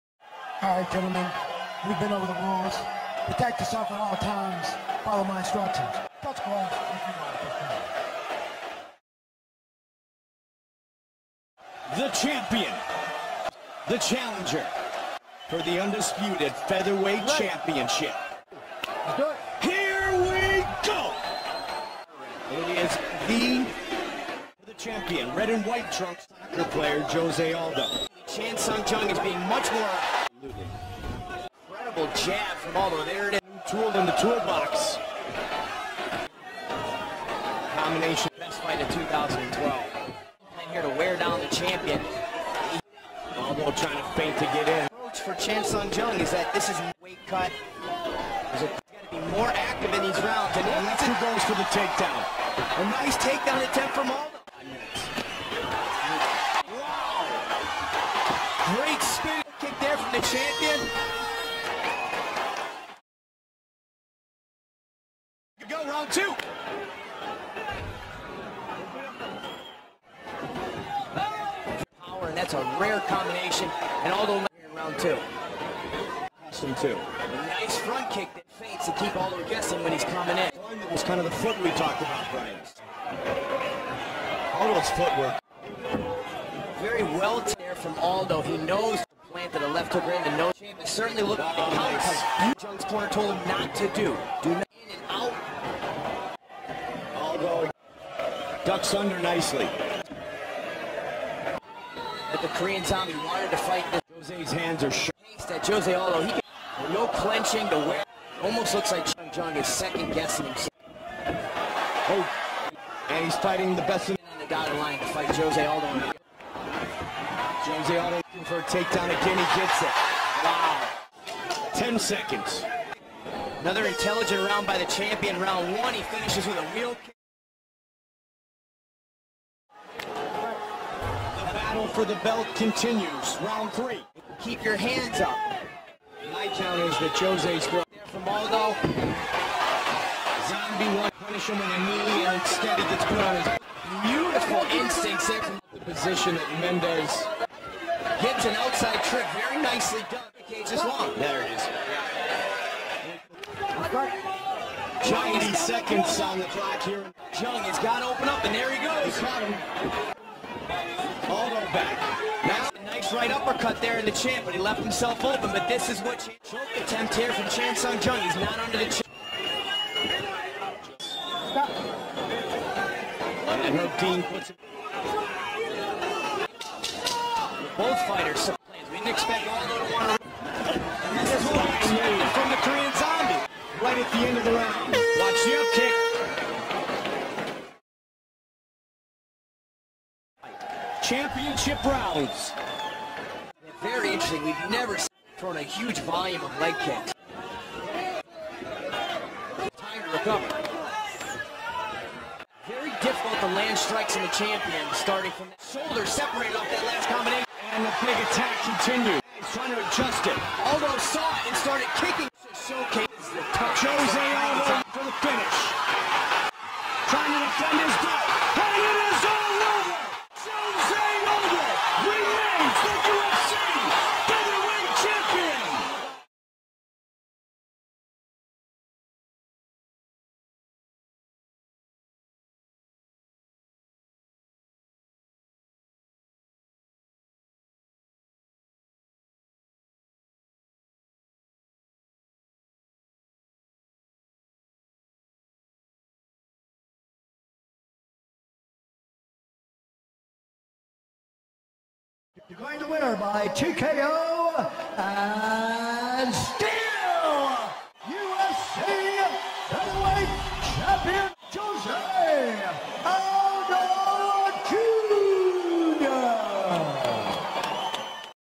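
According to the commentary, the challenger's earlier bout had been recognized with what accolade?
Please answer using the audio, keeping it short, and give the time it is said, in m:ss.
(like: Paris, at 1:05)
Best fight of 2012, at 0:38.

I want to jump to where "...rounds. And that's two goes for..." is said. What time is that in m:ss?
0:50.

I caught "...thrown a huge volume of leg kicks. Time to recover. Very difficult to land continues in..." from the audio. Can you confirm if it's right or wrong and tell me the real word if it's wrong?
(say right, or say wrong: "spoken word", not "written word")
wrong: "strikes", not "continues".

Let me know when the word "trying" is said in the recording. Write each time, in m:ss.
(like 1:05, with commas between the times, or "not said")
0:43, 3:29, 3:37.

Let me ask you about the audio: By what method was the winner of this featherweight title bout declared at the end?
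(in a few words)
TKO.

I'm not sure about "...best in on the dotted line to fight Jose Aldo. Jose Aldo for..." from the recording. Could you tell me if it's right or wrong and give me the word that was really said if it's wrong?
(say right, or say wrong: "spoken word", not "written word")
right.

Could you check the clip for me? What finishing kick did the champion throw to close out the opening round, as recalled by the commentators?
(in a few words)
Wheel kick.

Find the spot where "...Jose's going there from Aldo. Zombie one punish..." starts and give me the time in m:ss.
2:17.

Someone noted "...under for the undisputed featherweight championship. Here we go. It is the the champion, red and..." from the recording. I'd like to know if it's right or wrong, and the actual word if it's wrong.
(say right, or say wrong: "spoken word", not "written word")
wrong: "challenger", not "under".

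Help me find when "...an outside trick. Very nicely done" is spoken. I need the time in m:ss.
2:28.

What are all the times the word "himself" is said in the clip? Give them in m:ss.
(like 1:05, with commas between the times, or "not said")
1:50, 2:44.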